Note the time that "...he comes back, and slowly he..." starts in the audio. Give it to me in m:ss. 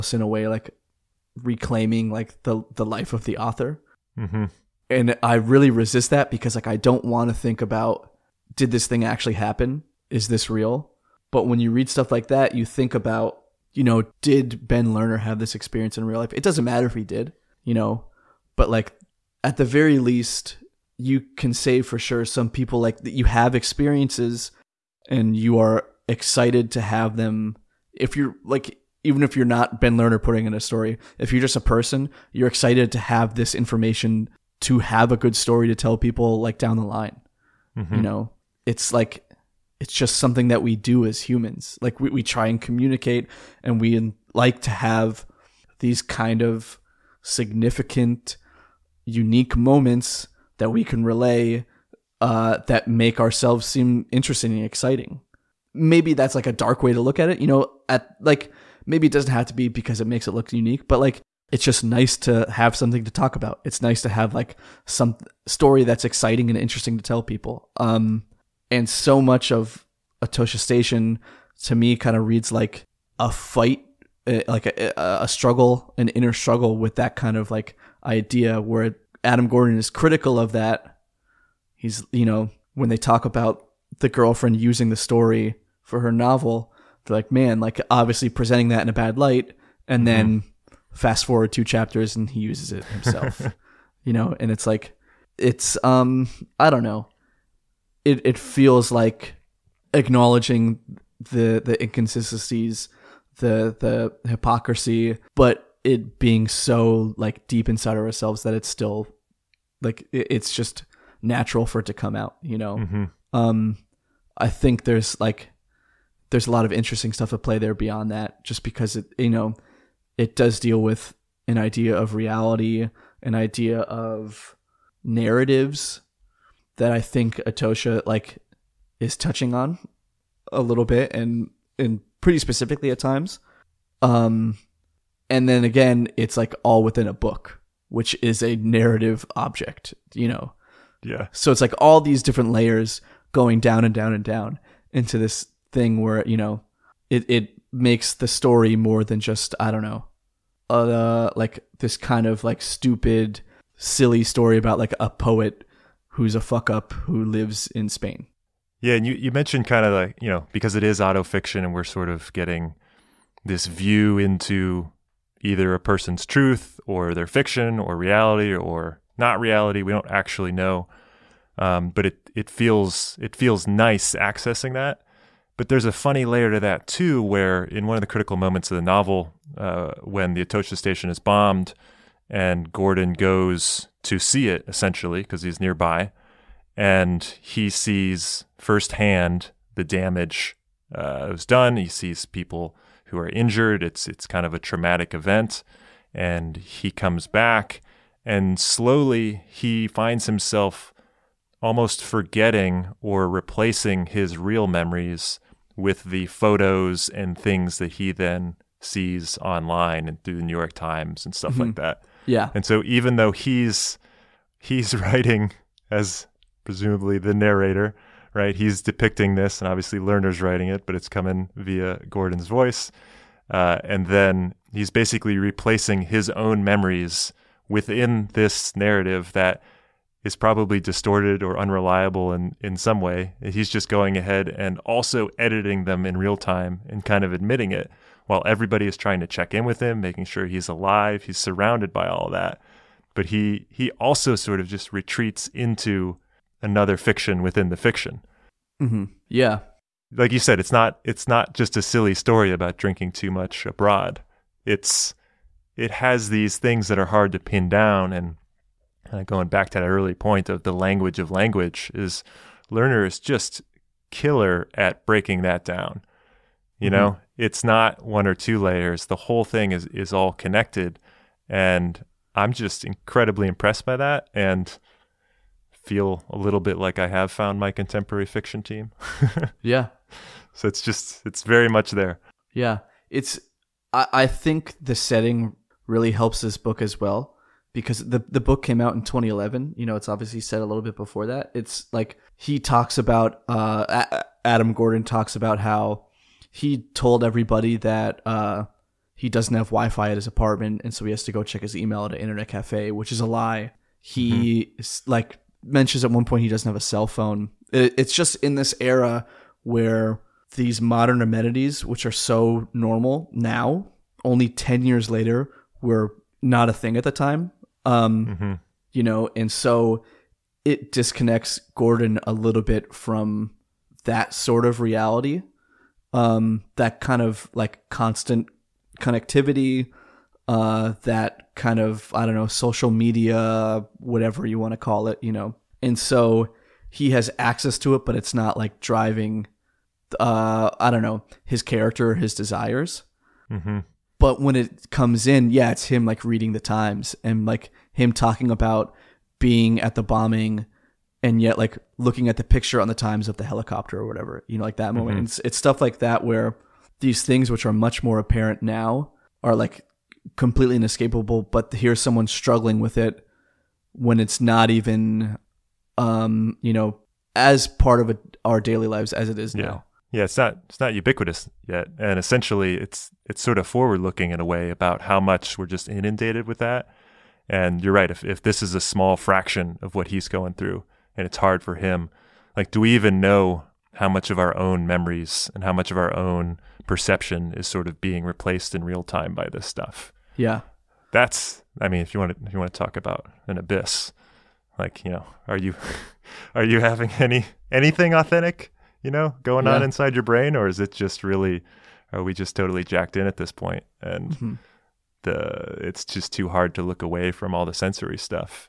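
3:16.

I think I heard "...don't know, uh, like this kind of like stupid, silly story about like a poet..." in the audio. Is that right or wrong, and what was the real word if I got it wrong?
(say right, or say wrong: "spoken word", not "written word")
right.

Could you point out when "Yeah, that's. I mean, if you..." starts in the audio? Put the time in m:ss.
6:30.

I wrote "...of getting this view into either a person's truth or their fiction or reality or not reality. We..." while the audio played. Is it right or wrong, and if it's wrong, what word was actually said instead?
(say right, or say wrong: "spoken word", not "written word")
right.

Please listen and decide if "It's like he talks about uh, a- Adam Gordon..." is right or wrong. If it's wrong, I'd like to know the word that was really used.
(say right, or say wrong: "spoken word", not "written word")
right.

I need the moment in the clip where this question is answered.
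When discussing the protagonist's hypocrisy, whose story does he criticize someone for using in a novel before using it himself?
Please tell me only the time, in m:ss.
1:24.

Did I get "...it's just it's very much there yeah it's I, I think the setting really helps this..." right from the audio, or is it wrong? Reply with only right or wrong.
right.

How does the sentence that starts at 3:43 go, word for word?
Uh, and then he's basically replacing his own memories within this narrative that is probably distorted or unreliable in, in some way.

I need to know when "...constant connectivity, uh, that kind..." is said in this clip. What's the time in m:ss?
5:27.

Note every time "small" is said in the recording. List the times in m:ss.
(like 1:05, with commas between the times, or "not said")
6:18.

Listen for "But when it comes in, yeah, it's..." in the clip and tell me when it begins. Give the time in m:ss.
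5:44.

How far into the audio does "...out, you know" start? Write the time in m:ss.
1:52.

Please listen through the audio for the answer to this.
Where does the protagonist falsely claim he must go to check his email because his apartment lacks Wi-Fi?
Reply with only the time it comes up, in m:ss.
5:02.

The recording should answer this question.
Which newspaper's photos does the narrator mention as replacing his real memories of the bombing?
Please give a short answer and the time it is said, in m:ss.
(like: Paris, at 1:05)
The New York Times, at 3:30.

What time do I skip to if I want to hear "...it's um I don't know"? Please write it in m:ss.
1:35.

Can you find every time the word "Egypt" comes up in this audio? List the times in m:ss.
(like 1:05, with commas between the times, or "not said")
not said.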